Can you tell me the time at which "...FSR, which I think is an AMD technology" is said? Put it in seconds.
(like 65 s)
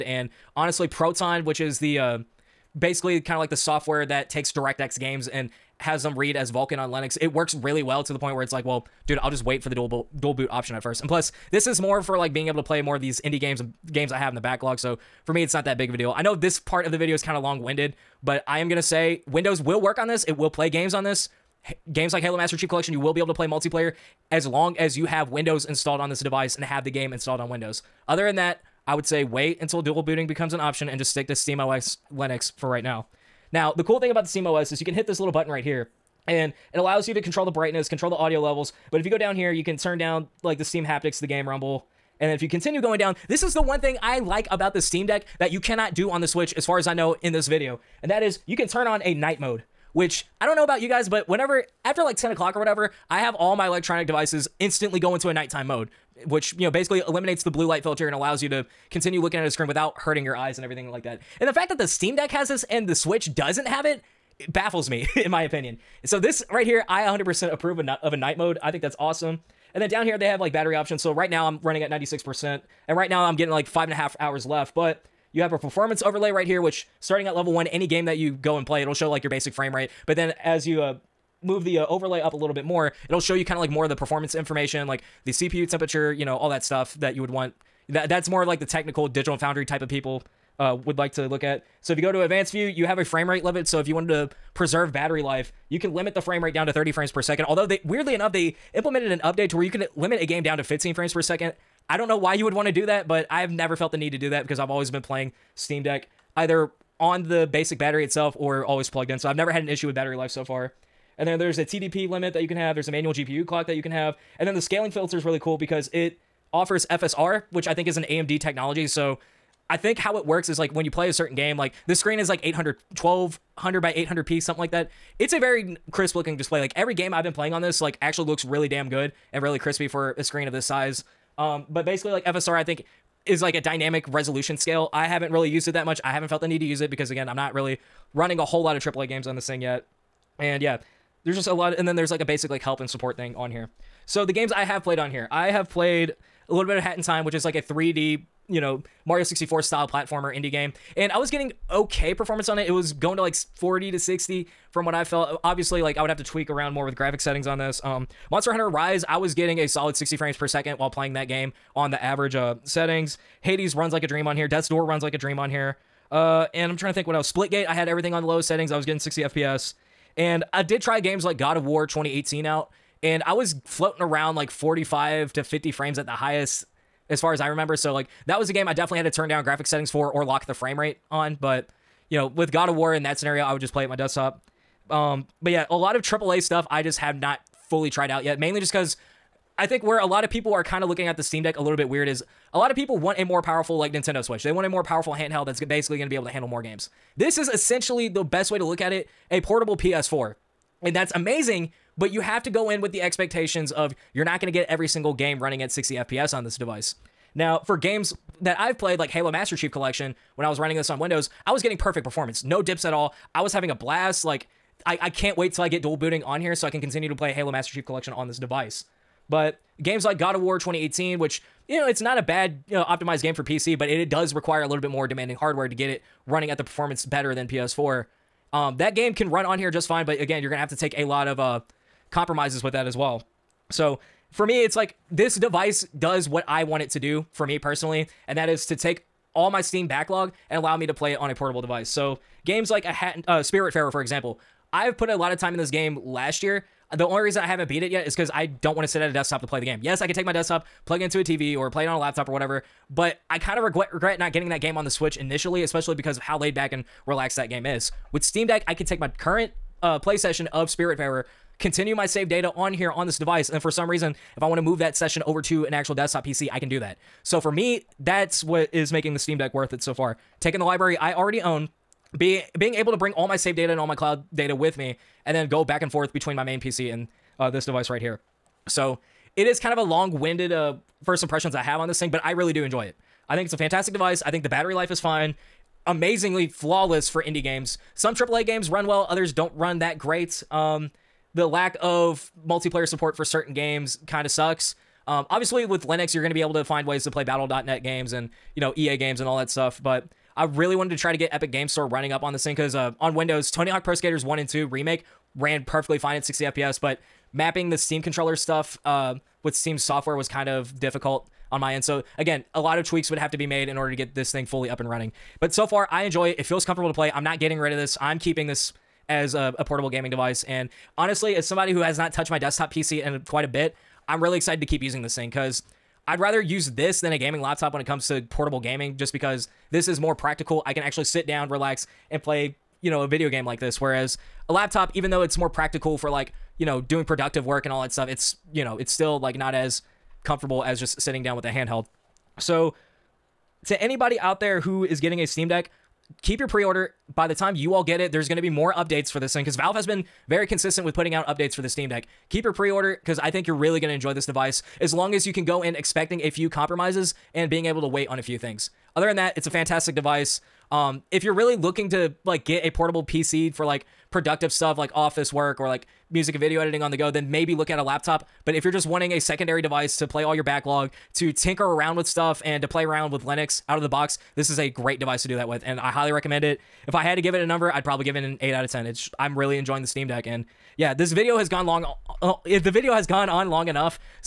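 116 s.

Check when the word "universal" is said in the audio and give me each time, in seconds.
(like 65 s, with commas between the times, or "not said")
not said.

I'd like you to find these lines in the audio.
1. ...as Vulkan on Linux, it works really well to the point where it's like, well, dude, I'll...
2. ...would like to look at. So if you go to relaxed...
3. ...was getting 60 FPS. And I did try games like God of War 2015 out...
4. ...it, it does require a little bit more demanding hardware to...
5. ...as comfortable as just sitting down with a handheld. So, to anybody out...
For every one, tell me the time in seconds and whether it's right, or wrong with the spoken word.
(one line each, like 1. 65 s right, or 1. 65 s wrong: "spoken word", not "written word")
1. 6 s right
2. 90 s wrong: "advanced", not "relaxed"
3. 168 s wrong: "2018", not "2015"
4. 223 s right
5. 339 s right.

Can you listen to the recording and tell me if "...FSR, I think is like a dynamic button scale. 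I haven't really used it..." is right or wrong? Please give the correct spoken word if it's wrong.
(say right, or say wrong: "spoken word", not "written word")
wrong: "resolution", not "button".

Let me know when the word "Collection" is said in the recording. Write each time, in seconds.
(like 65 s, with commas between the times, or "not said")
22 s, 209 s, 217 s.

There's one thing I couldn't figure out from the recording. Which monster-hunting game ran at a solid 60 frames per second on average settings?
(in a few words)
Monster Hunter Rise.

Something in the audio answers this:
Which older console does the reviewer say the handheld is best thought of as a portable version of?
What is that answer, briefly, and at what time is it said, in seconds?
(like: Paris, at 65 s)
PS4, at 199 s.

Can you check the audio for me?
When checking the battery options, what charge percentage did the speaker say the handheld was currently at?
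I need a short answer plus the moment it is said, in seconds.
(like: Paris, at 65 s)
96%, at 71 s.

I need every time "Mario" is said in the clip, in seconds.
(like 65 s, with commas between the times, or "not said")
149 s.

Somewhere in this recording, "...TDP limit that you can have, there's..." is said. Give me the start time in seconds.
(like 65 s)
111 s.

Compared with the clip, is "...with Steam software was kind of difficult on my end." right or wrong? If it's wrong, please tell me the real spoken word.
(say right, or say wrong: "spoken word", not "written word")
right.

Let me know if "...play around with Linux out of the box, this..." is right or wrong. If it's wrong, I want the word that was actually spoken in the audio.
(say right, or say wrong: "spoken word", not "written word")
right.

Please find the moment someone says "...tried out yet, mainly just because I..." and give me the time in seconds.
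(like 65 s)
187 s.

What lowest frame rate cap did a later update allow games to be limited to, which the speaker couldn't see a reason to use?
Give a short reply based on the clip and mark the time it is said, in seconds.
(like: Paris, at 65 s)
15 frames per second, at 100 s.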